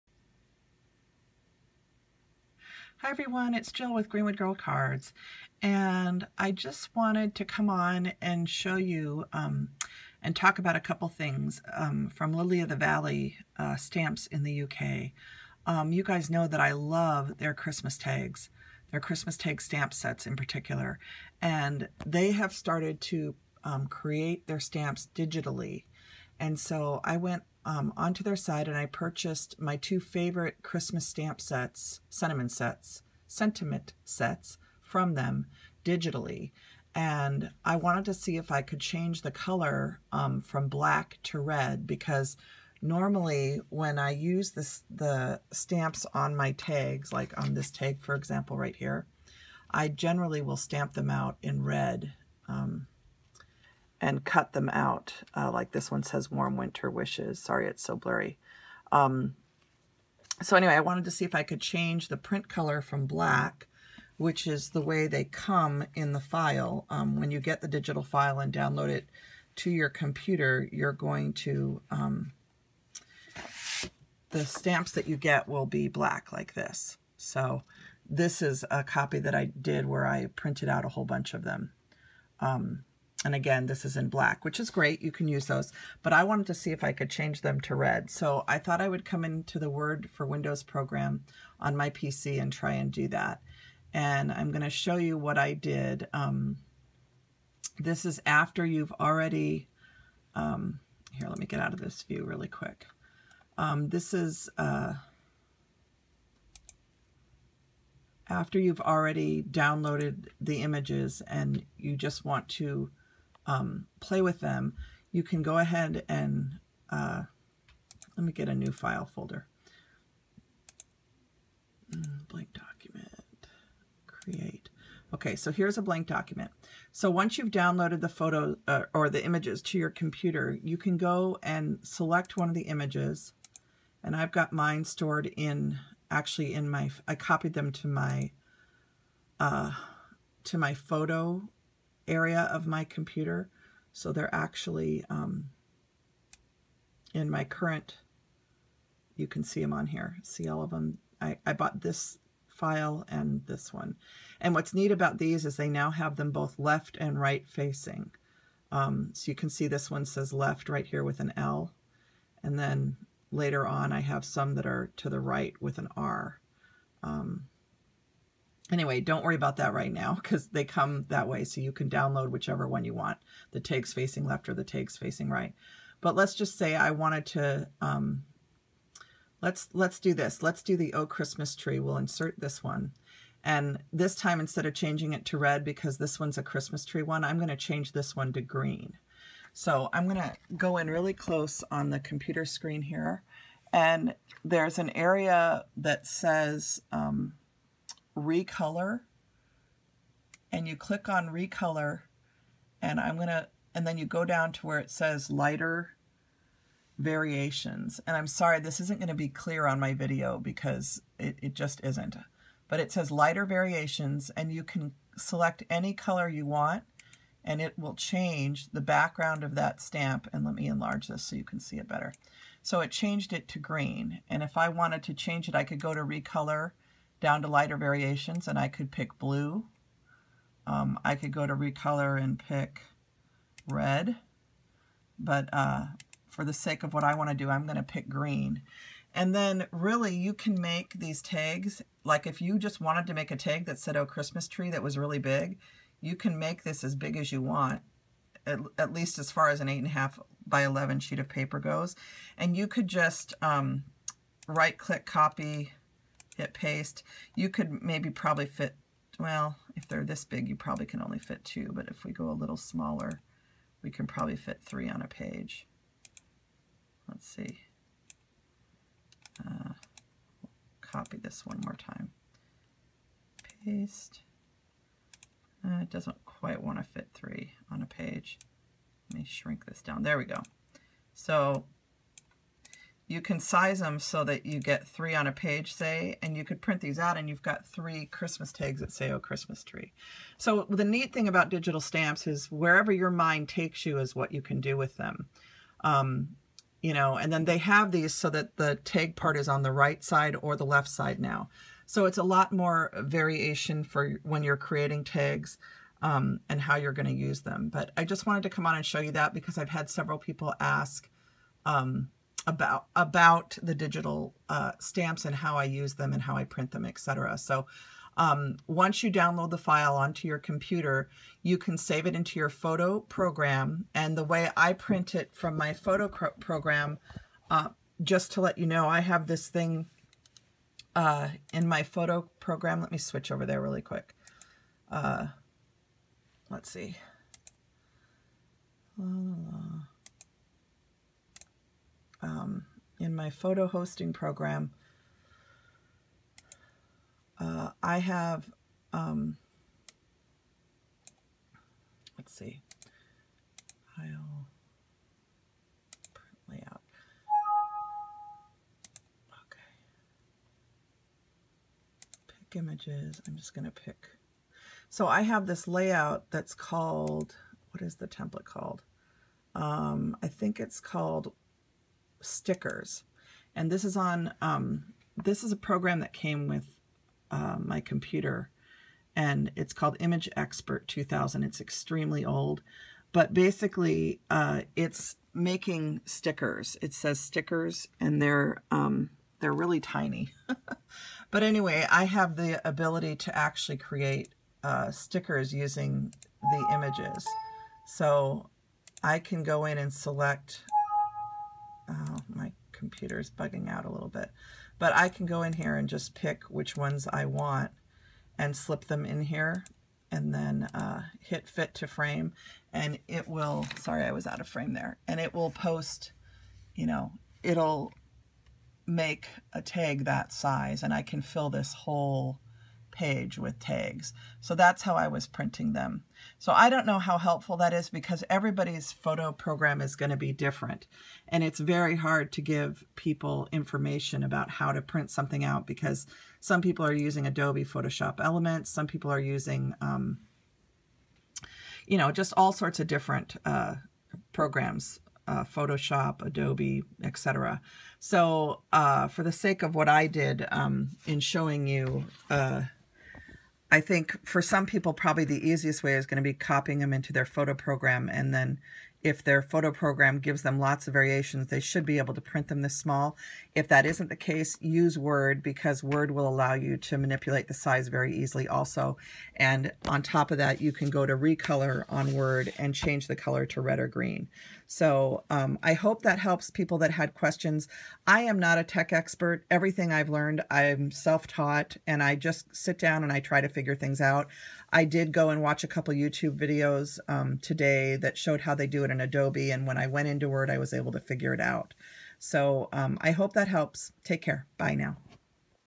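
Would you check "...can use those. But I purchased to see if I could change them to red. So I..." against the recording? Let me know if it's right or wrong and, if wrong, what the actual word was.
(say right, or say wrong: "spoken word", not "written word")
wrong: "wanted", not "purchased".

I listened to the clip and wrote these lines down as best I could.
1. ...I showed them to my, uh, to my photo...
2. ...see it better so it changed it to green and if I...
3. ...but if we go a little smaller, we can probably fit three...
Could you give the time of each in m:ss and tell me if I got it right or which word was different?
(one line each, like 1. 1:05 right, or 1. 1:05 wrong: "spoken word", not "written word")
1. 2:17 wrong: "copied", not "showed"
2. 3:41 right
3. 4:21 right.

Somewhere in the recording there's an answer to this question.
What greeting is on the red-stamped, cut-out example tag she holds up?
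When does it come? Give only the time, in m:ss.
0:56.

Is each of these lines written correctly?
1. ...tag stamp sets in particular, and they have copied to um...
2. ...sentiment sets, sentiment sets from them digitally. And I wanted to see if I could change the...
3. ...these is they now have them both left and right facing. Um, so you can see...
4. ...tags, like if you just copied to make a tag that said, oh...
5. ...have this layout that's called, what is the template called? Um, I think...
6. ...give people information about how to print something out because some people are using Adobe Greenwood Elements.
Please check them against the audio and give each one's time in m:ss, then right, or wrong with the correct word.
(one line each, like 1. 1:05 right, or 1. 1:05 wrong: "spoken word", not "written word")
1. 0:19 wrong: "started", not "copied"
2. 0:32 right
3. 2:35 right
4. 4:01 wrong: "wanted", not "copied"
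5. 6:05 right
6. 7:12 wrong: "Photoshop", not "Greenwood".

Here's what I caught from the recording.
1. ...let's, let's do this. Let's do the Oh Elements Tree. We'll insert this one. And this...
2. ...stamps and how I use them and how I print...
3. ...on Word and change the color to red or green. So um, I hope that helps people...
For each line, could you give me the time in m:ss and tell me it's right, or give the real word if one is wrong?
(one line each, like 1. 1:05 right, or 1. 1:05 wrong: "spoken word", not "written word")
1. 2:59 wrong: "Christmas", not "Elements"
2. 5:14 right
3. 7:51 right.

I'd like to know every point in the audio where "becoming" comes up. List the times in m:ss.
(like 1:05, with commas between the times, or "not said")
not said.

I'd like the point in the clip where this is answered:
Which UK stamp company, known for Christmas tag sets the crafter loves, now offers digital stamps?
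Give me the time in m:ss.
0:12.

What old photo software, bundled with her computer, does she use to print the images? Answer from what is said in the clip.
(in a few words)
Image Expert 2000.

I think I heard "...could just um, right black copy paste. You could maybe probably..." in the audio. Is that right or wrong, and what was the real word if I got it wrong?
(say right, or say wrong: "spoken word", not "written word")
wrong: "click", not "black".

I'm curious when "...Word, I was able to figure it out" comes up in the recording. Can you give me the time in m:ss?
8:10.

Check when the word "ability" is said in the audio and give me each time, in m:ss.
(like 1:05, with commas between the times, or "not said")
6:32.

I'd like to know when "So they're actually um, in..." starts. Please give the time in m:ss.
2:23.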